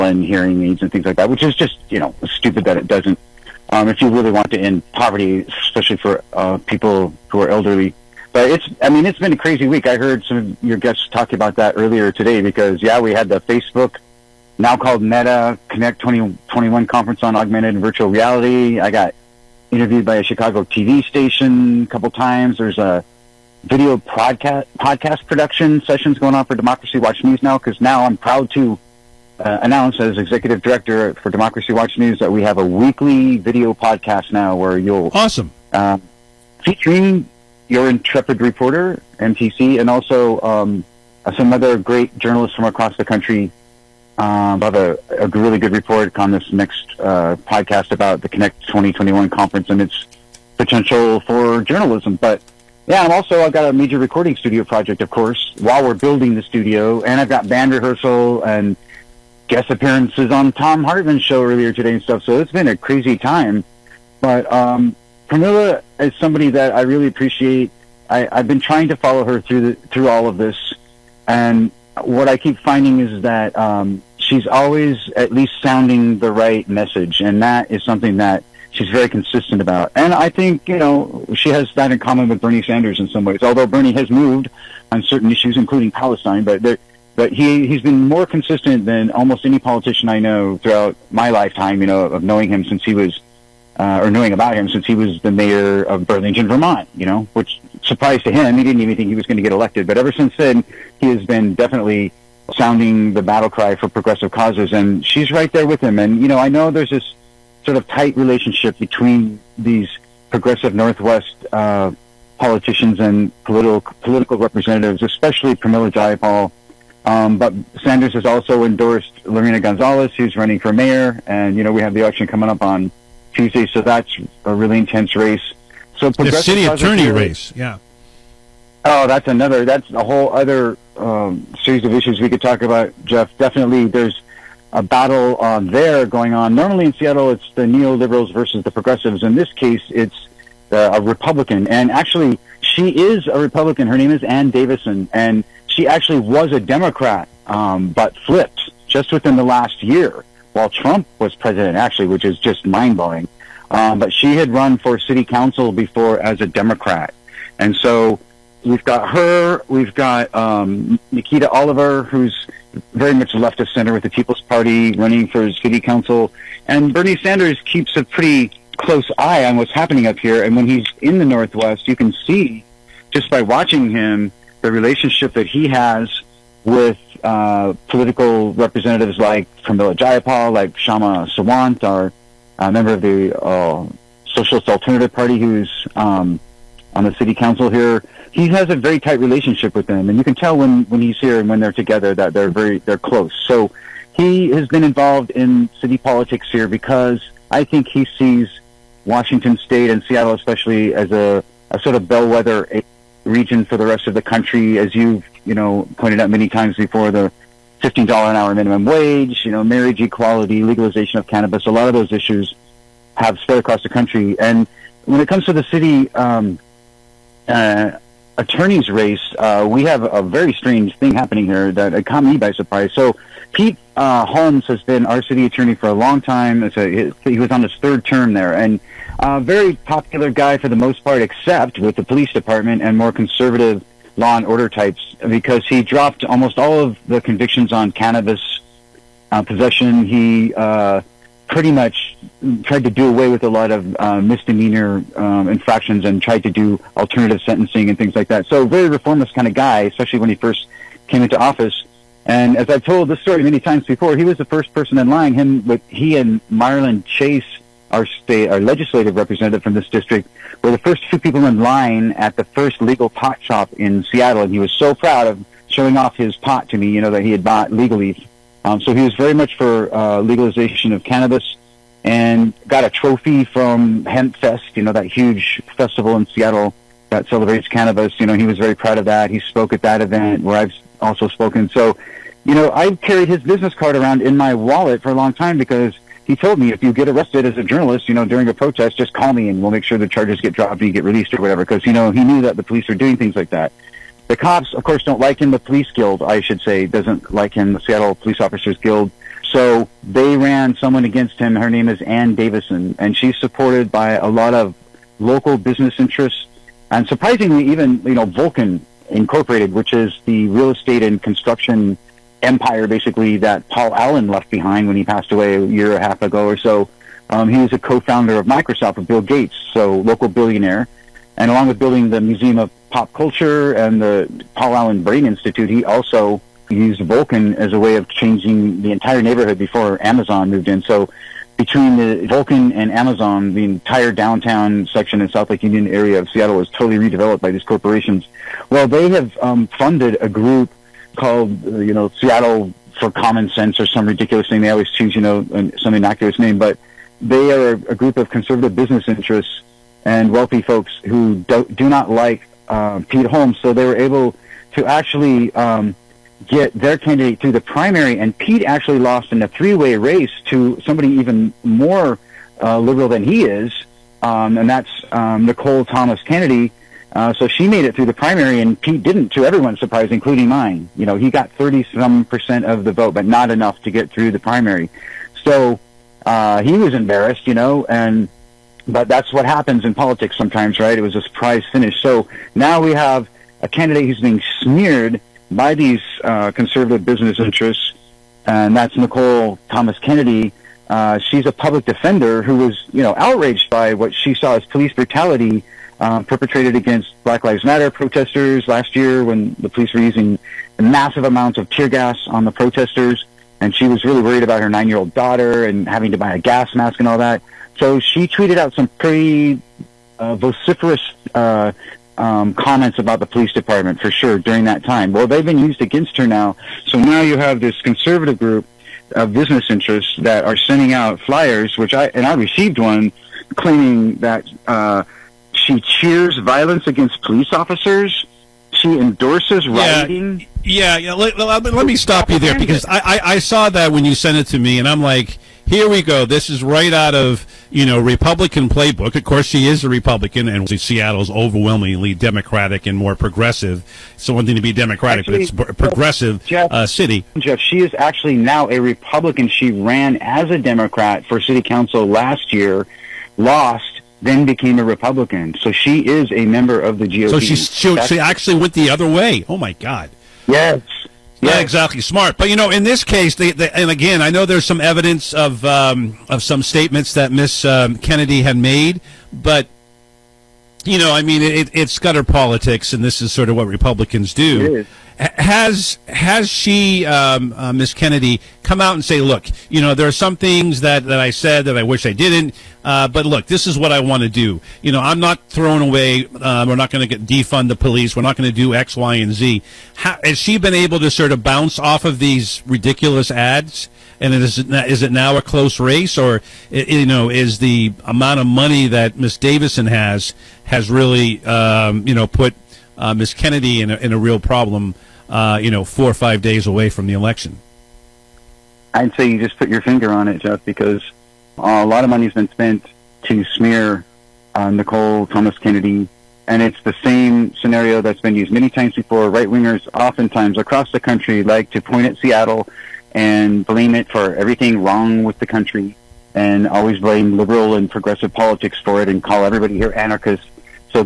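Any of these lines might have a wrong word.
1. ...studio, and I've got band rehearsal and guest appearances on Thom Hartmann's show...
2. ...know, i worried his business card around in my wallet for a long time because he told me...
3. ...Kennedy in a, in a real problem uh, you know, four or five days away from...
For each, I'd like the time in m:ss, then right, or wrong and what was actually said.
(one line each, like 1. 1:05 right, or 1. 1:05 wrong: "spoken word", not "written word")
1. 0:56 right
2. 4:42 wrong: "carried", not "worried"
3. 8:23 right.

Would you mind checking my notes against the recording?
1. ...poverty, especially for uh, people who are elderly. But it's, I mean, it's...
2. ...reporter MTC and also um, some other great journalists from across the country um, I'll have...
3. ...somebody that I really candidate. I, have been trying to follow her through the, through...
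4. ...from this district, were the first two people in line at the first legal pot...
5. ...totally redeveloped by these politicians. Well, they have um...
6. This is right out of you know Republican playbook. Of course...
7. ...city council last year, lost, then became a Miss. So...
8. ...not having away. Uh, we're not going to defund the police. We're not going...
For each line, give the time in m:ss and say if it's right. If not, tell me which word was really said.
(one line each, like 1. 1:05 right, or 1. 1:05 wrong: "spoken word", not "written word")
1. 0:04 right
2. 0:38 right
3. 1:06 wrong: "appreciate", not "candidate"
4. 4:19 right
5. 5:36 wrong: "corporations", not "politicians"
6. 7:16 right
7. 7:31 wrong: "Republican", not "Miss"
8. 8:05 wrong: "throwing", not "having".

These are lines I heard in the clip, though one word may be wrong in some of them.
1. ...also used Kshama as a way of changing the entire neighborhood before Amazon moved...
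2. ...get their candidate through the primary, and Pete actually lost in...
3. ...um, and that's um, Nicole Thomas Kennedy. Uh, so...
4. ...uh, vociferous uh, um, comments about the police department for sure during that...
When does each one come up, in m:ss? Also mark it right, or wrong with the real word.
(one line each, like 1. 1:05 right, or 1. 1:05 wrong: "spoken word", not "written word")
1. 5:25 wrong: "Vulcan", not "Kshama"
2. 5:56 right
3. 6:04 right
4. 6:50 right.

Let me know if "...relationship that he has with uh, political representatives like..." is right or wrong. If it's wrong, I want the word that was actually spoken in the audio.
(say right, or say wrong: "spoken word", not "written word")
right.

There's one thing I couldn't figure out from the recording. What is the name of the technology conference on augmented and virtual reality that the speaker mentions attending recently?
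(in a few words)
Meta Connect 2021.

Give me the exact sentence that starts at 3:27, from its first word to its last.
$15 an hour minimum wage, you know, marriage equality, legalization of cannabis, a lot of those issues have spread across the country.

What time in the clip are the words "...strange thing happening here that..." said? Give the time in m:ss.
3:40.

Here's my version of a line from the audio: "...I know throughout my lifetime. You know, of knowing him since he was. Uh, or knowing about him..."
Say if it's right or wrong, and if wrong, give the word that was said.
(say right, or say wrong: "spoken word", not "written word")
right.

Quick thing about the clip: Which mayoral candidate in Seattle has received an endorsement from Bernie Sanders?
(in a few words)
Lorena Gonzalez.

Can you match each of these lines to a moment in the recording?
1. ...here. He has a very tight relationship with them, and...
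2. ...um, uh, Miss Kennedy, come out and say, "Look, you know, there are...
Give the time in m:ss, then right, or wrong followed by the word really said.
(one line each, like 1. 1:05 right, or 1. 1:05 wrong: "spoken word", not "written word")
1. 3:07 right
2. 7:57 right.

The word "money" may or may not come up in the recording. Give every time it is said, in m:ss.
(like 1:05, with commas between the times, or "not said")
8:18, 8:32.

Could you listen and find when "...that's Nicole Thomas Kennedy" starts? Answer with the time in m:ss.
6:28.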